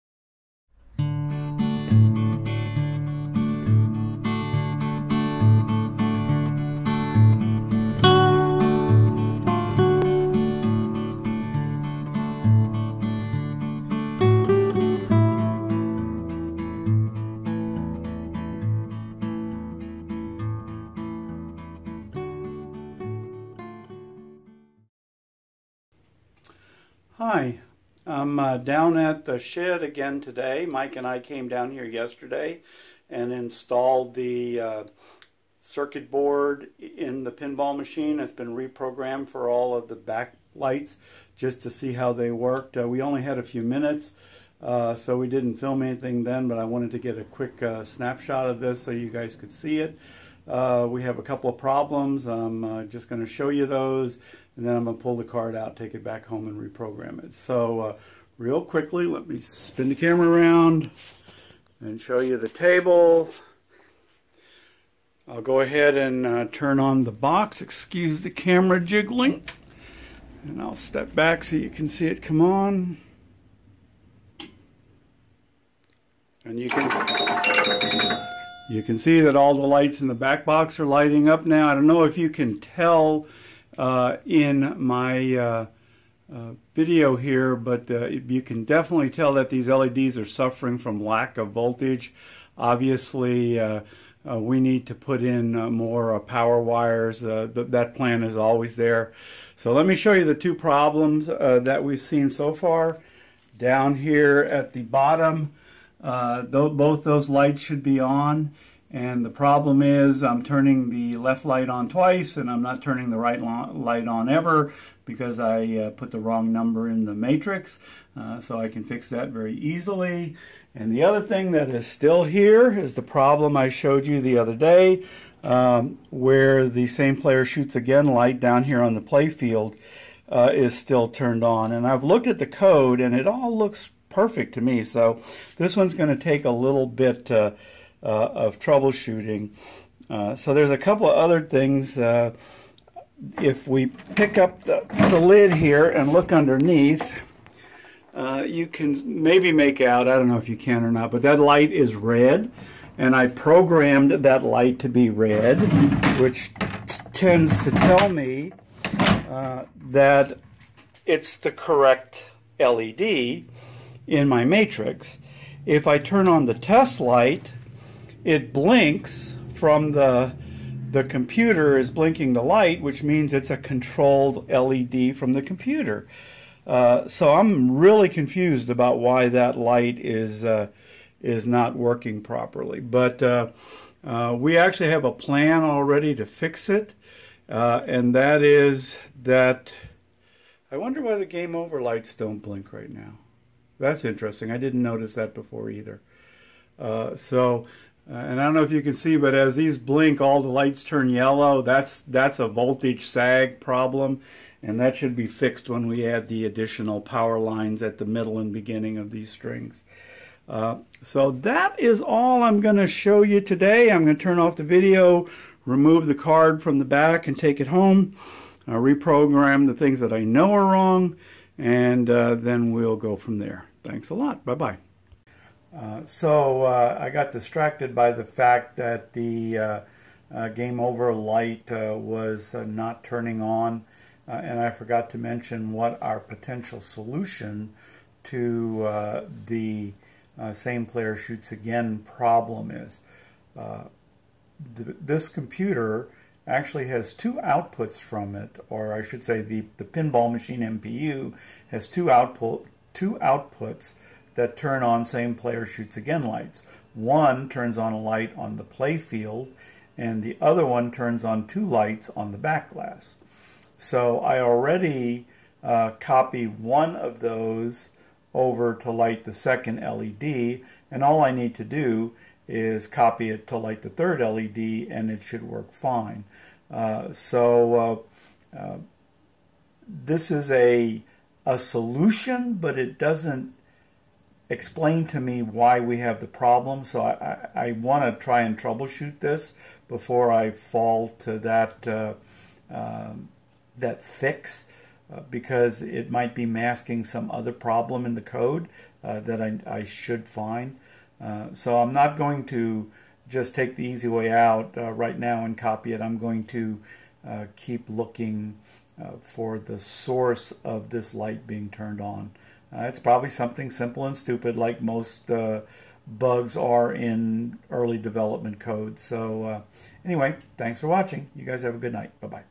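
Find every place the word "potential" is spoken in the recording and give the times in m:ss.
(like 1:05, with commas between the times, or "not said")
3:56.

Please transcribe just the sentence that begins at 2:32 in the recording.
And I programmed that light to be red, which tends to tell me uh, that it's the correct LED in my matrix.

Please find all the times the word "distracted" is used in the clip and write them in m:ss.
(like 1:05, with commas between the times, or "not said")
3:47.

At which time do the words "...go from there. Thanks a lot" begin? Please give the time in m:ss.
3:42.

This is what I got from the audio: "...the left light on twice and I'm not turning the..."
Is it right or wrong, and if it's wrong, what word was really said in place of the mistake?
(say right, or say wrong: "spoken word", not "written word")
right.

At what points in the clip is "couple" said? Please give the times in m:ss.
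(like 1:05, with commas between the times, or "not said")
0:51, 2:20.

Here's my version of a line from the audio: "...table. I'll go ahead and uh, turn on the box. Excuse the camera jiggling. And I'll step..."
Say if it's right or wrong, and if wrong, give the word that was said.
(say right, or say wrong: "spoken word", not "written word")
right.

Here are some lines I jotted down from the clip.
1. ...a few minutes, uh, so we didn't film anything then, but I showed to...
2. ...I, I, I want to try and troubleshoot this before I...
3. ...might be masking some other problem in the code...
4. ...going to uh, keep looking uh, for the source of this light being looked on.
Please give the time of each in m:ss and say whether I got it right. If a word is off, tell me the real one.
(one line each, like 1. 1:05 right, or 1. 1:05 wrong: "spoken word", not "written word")
1. 0:43 wrong: "wanted", not "showed"
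2. 4:47 right
3. 4:56 right
4. 5:06 wrong: "turned", not "looked".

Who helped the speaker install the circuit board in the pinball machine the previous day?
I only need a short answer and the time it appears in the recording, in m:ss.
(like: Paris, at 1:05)
Mike, at 0:30.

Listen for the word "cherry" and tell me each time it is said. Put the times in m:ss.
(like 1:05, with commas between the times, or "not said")
not said.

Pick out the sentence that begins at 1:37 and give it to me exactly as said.
Th that plan is always there.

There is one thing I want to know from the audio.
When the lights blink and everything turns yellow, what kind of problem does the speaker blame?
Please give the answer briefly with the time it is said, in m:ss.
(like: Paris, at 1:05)
Voltage sag, at 3:22.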